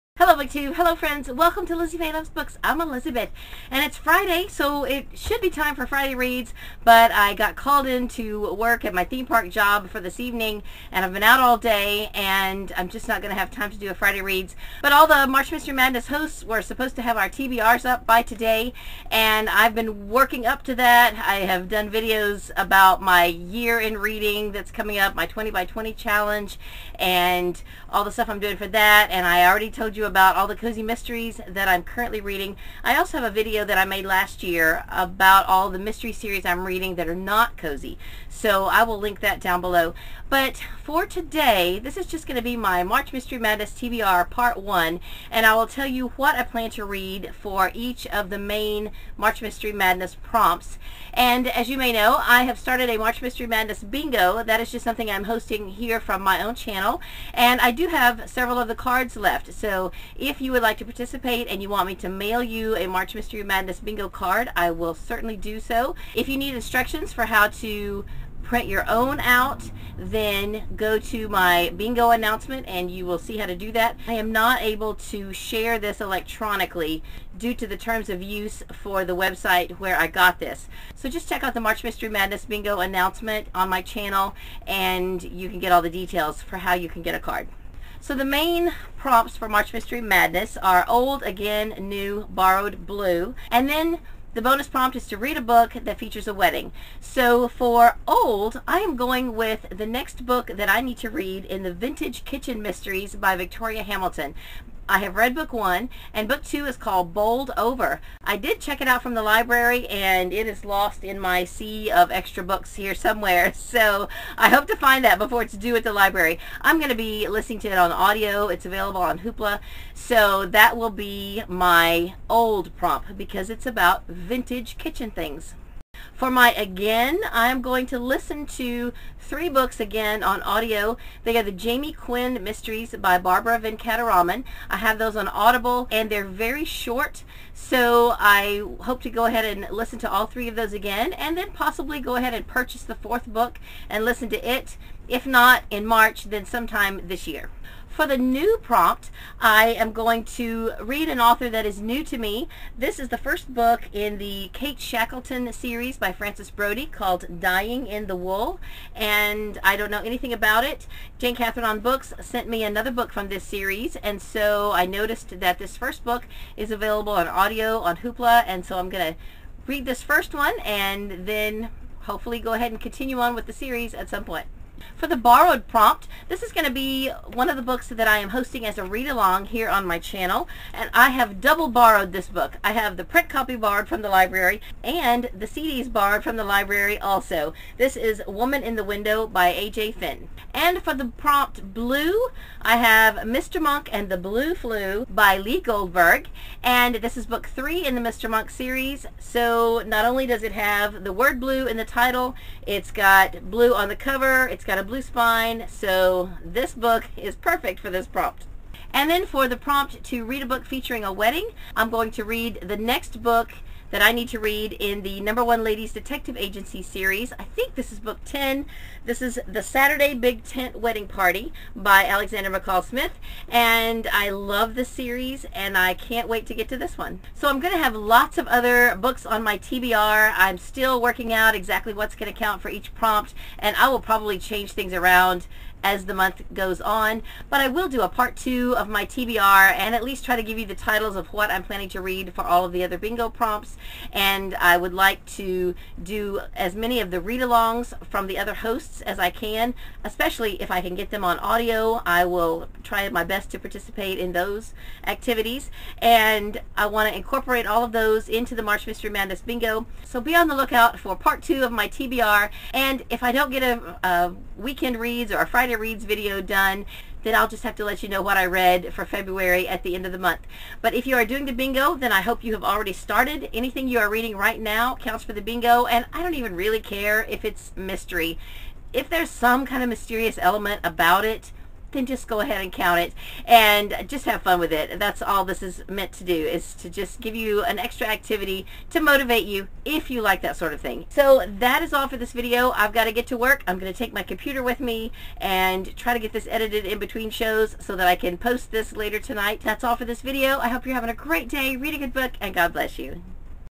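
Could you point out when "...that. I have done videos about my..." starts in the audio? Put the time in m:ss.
0:20.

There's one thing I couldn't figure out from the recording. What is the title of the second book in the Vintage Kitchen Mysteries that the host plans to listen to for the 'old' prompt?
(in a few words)
Bowled Over.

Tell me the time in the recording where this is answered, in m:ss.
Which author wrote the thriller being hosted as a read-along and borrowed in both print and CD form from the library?
3:09.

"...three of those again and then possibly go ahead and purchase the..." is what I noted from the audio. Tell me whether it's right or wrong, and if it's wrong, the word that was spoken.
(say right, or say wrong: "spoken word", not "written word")
right.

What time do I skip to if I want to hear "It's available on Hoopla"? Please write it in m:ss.
1:58.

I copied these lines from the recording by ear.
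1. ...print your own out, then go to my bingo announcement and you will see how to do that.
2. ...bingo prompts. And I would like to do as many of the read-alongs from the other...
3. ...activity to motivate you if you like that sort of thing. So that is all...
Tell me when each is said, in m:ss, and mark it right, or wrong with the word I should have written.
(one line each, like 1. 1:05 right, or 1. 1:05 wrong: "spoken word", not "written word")
1. 1:08 right
2. 4:02 right
3. 4:48 right.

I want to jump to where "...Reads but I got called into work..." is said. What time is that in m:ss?
0:06.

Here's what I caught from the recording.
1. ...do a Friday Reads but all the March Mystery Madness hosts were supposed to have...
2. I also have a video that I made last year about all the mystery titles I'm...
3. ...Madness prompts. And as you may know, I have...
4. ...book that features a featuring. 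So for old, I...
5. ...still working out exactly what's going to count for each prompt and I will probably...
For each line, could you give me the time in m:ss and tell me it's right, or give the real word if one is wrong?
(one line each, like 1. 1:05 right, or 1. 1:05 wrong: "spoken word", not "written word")
1. 0:13 right
2. 0:32 wrong: "series", not "titles"
3. 0:49 right
4. 1:35 wrong: "wedding", not "featuring"
5. 3:50 right.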